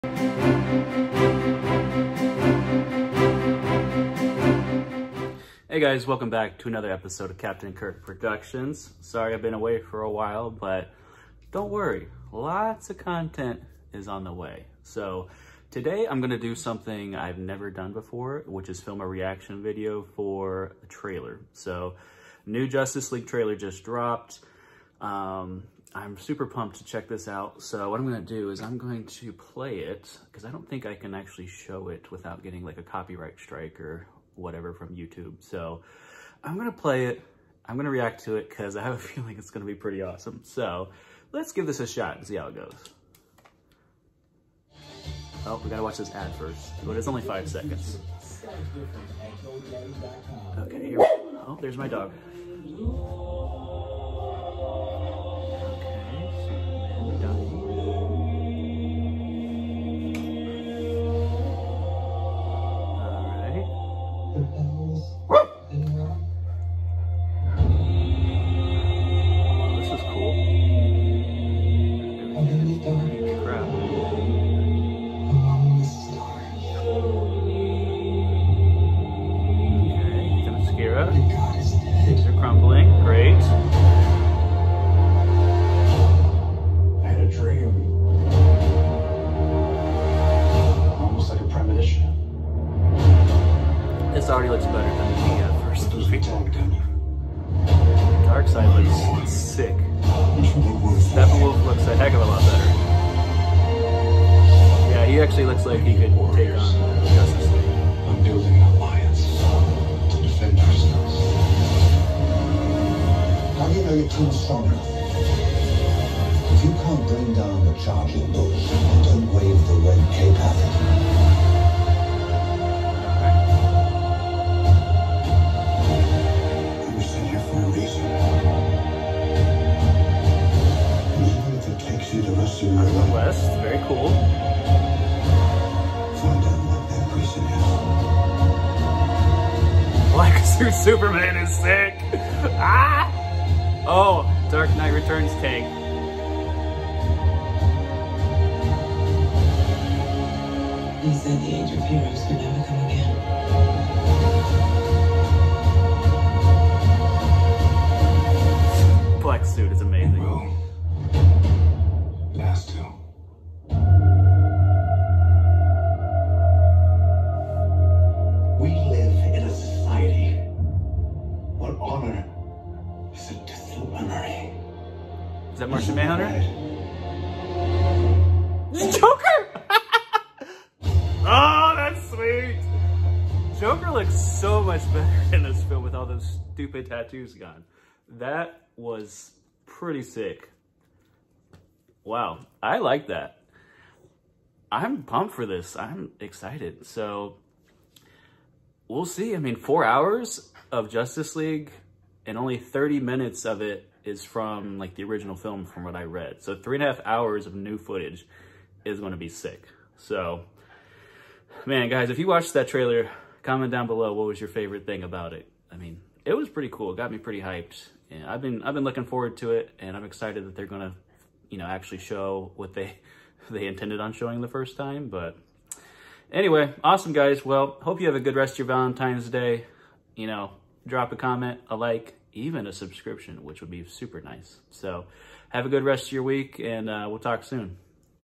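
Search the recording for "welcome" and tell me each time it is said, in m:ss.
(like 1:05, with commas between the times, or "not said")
0:06.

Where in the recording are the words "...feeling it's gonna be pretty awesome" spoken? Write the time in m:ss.
0:38.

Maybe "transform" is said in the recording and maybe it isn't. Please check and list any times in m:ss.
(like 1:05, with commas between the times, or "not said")
not said.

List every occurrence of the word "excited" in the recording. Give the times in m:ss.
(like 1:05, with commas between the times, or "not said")
3:16, 3:40.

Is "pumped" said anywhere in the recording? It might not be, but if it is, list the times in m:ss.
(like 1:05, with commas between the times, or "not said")
0:26, 3:15.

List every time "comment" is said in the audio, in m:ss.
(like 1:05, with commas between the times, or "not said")
3:33, 3:51.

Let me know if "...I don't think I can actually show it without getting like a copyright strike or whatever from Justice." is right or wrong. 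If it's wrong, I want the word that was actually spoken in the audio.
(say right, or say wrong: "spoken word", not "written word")
wrong: "YouTube", not "Justice".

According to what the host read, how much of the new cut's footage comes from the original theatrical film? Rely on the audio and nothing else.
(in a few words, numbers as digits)
30 minutes.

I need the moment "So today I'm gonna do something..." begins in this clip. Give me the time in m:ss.
0:14.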